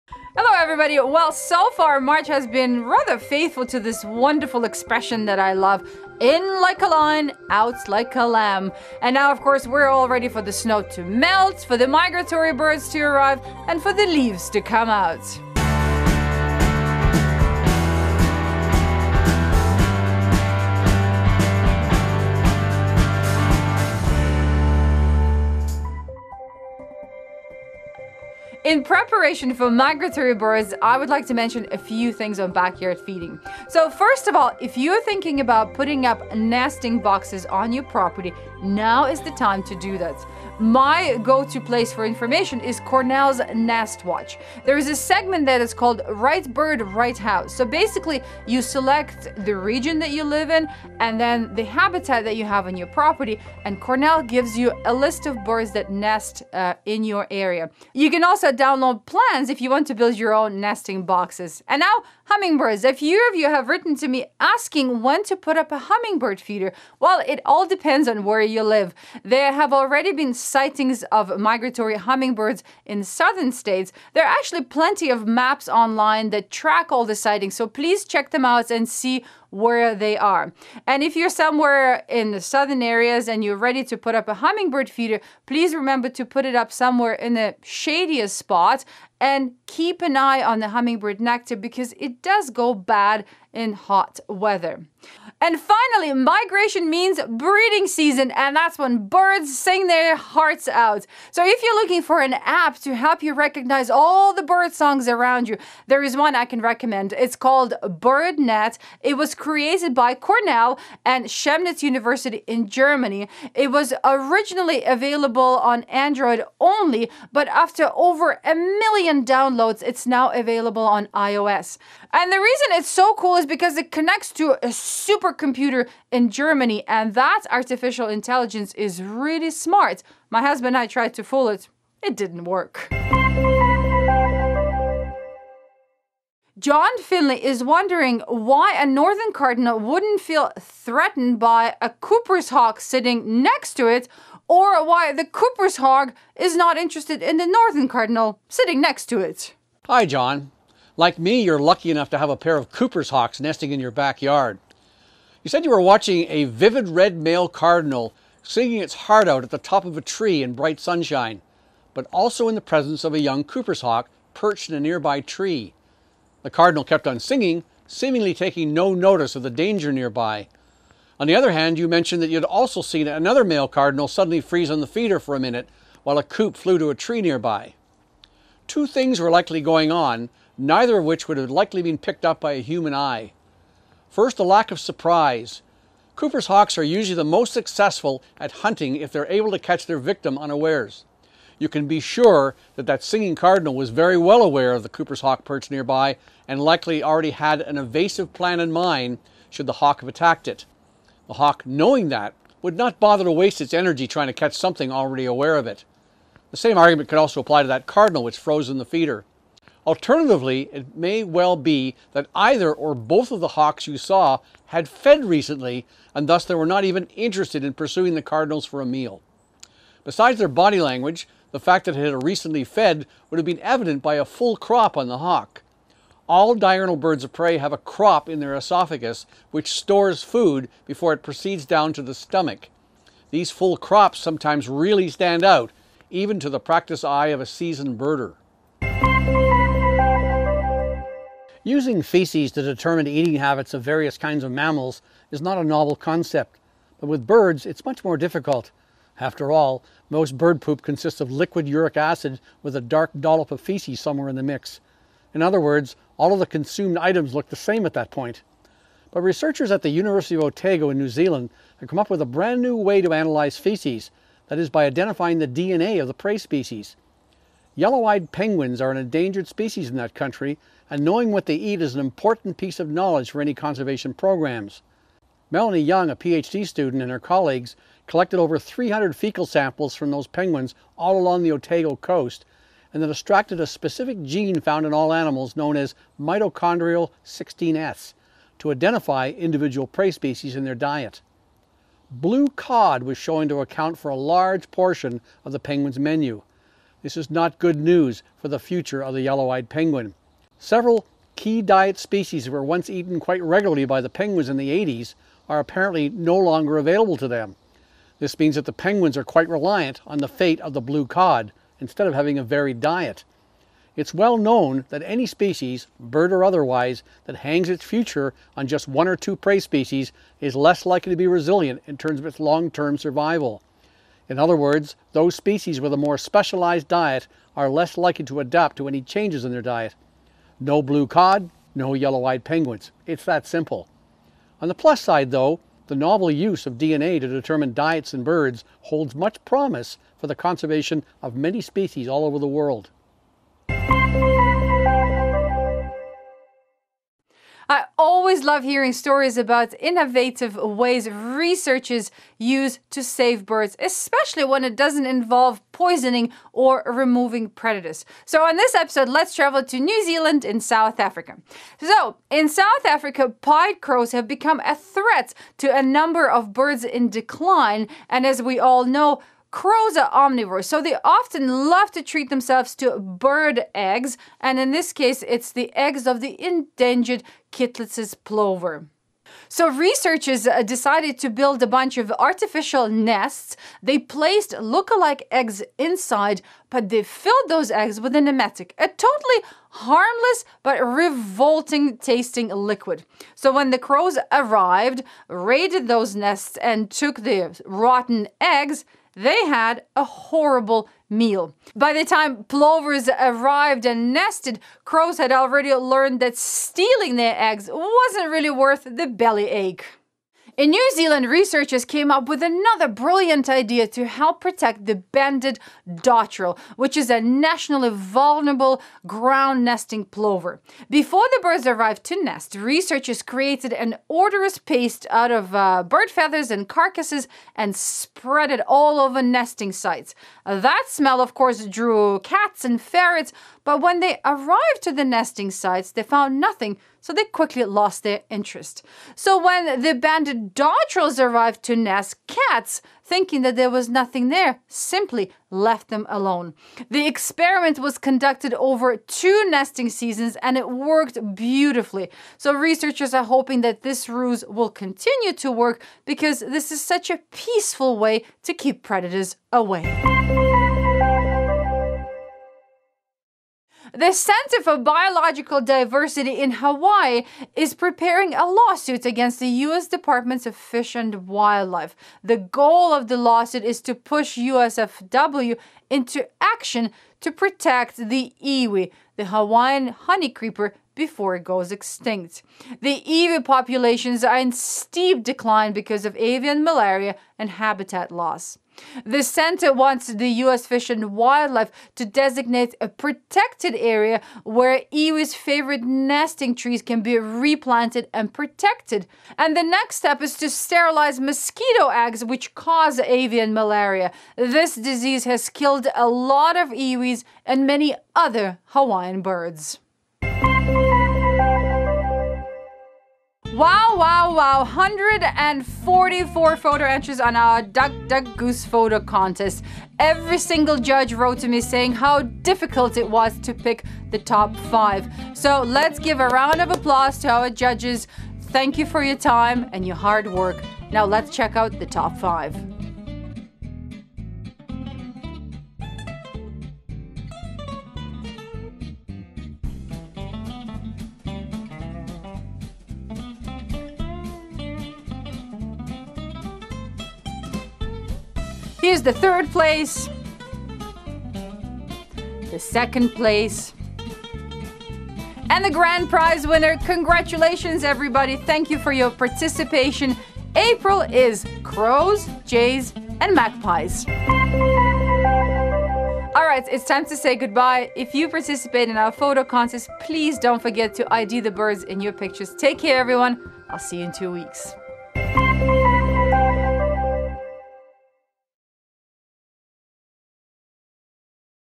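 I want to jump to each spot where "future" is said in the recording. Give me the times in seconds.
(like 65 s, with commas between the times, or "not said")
298 s, 317 s.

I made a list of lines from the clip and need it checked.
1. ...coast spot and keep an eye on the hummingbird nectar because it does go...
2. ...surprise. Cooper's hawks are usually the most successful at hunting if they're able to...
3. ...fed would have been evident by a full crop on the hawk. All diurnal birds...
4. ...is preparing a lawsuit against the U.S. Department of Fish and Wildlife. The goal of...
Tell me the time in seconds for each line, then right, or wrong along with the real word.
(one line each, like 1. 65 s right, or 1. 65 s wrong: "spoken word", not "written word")
1. 87 s wrong: "shadiest", not "coast"
2. 184 s right
3. 222 s right
4. 467 s right.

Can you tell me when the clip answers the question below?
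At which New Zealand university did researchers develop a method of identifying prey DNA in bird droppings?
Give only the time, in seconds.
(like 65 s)
259 s.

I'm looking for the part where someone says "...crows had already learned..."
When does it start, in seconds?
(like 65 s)
404 s.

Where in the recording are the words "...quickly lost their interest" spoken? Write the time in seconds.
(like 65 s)
437 s.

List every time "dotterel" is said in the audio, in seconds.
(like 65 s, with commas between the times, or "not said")
415 s, 440 s.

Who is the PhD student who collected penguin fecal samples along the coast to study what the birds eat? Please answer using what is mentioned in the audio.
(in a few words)
Melanie Young.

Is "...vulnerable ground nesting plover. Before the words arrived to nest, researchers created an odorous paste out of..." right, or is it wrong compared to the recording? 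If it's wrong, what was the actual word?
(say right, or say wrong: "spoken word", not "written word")
wrong: "birds", not "words".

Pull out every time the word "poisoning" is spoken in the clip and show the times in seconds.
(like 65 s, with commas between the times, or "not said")
355 s.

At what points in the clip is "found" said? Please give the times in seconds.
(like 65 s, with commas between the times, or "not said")
284 s, 436 s.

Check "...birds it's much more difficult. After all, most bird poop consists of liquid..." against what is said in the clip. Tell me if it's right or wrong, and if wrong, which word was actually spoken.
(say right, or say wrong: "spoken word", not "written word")
right.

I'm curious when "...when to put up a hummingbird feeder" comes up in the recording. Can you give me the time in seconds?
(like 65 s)
65 s.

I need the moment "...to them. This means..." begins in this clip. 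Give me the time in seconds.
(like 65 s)
307 s.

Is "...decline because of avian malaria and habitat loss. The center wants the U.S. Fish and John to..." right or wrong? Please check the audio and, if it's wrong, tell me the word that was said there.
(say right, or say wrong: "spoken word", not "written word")
wrong: "Wildlife", not "John".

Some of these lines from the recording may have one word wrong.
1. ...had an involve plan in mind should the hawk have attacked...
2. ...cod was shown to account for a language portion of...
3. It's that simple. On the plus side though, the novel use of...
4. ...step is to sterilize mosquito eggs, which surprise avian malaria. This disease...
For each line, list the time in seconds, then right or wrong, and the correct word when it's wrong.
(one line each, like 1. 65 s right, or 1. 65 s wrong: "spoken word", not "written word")
1. 197 s wrong: "evasive", not "involve"
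2. 292 s wrong: "large", not "language"
3. 333 s right
4. 499 s wrong: "cause", not "surprise".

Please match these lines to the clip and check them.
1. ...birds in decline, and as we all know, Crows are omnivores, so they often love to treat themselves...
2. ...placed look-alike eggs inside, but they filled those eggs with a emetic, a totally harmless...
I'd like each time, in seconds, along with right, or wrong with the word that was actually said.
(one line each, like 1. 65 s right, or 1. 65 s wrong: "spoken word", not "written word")
1. 366 s right
2. 383 s right.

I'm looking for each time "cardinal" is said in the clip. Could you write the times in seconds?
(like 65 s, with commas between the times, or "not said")
139 s, 147 s, 157 s, 166 s, 173 s, 193 s, 207 s, 218 s.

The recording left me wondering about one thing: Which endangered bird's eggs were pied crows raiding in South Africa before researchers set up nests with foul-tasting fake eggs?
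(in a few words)
Kittlitz's plover.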